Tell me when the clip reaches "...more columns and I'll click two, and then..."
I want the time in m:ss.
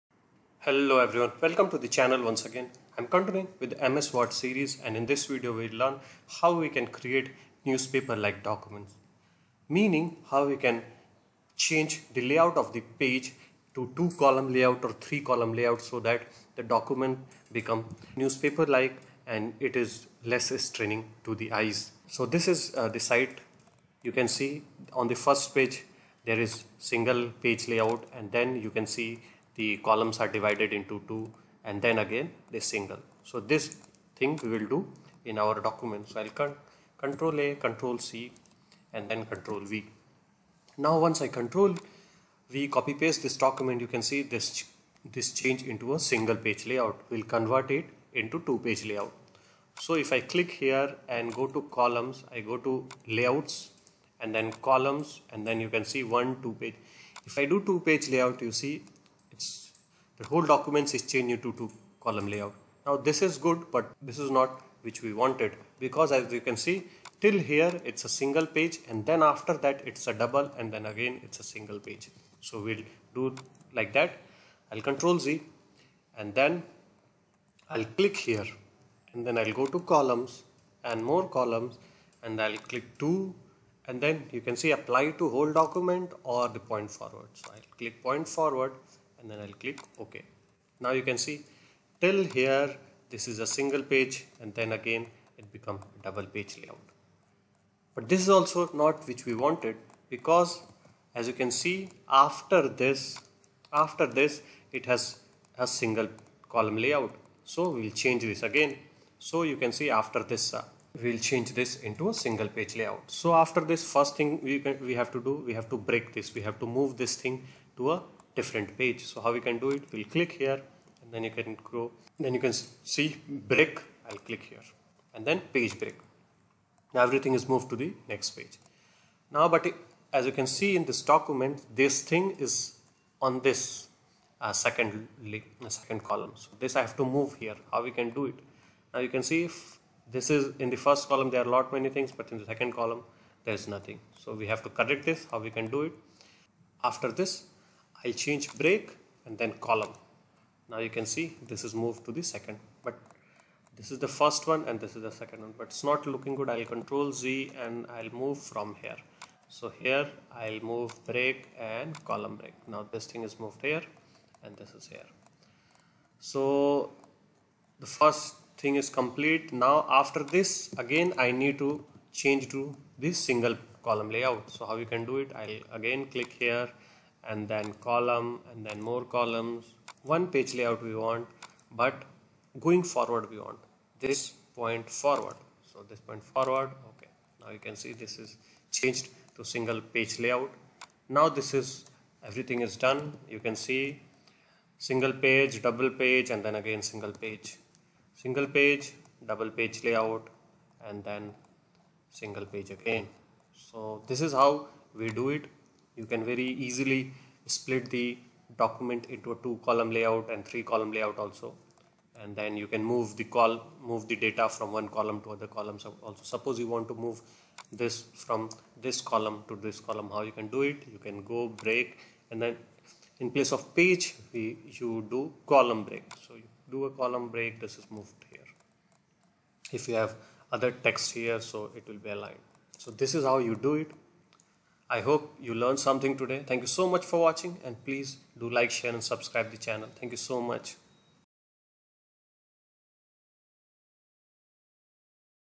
1:21.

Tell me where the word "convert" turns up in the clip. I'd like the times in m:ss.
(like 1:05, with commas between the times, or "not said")
0:47.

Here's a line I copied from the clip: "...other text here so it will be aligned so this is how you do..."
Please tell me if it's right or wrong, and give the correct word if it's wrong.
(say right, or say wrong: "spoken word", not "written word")
right.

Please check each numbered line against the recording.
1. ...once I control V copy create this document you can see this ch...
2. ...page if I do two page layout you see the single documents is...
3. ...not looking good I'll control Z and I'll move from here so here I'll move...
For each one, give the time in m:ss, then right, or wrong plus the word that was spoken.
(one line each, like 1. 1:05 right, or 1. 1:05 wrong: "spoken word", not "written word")
1. 0:40 wrong: "paste", not "create"
2. 0:56 wrong: "whole", not "single"
3. 2:35 right.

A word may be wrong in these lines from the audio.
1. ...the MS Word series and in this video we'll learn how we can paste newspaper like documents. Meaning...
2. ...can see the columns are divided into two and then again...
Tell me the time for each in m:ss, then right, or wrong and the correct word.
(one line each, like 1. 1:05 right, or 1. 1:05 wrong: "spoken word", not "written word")
1. 0:03 wrong: "create", not "paste"
2. 0:28 right.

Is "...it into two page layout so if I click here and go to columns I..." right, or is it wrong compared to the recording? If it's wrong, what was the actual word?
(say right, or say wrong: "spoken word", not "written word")
right.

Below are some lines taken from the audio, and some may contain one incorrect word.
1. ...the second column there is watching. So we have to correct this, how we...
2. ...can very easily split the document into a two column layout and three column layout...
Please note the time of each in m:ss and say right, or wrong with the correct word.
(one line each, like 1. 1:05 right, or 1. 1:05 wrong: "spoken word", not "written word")
1. 2:22 wrong: "nothing", not "watching"
2. 3:26 right.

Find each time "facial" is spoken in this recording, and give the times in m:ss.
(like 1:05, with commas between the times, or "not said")
not said.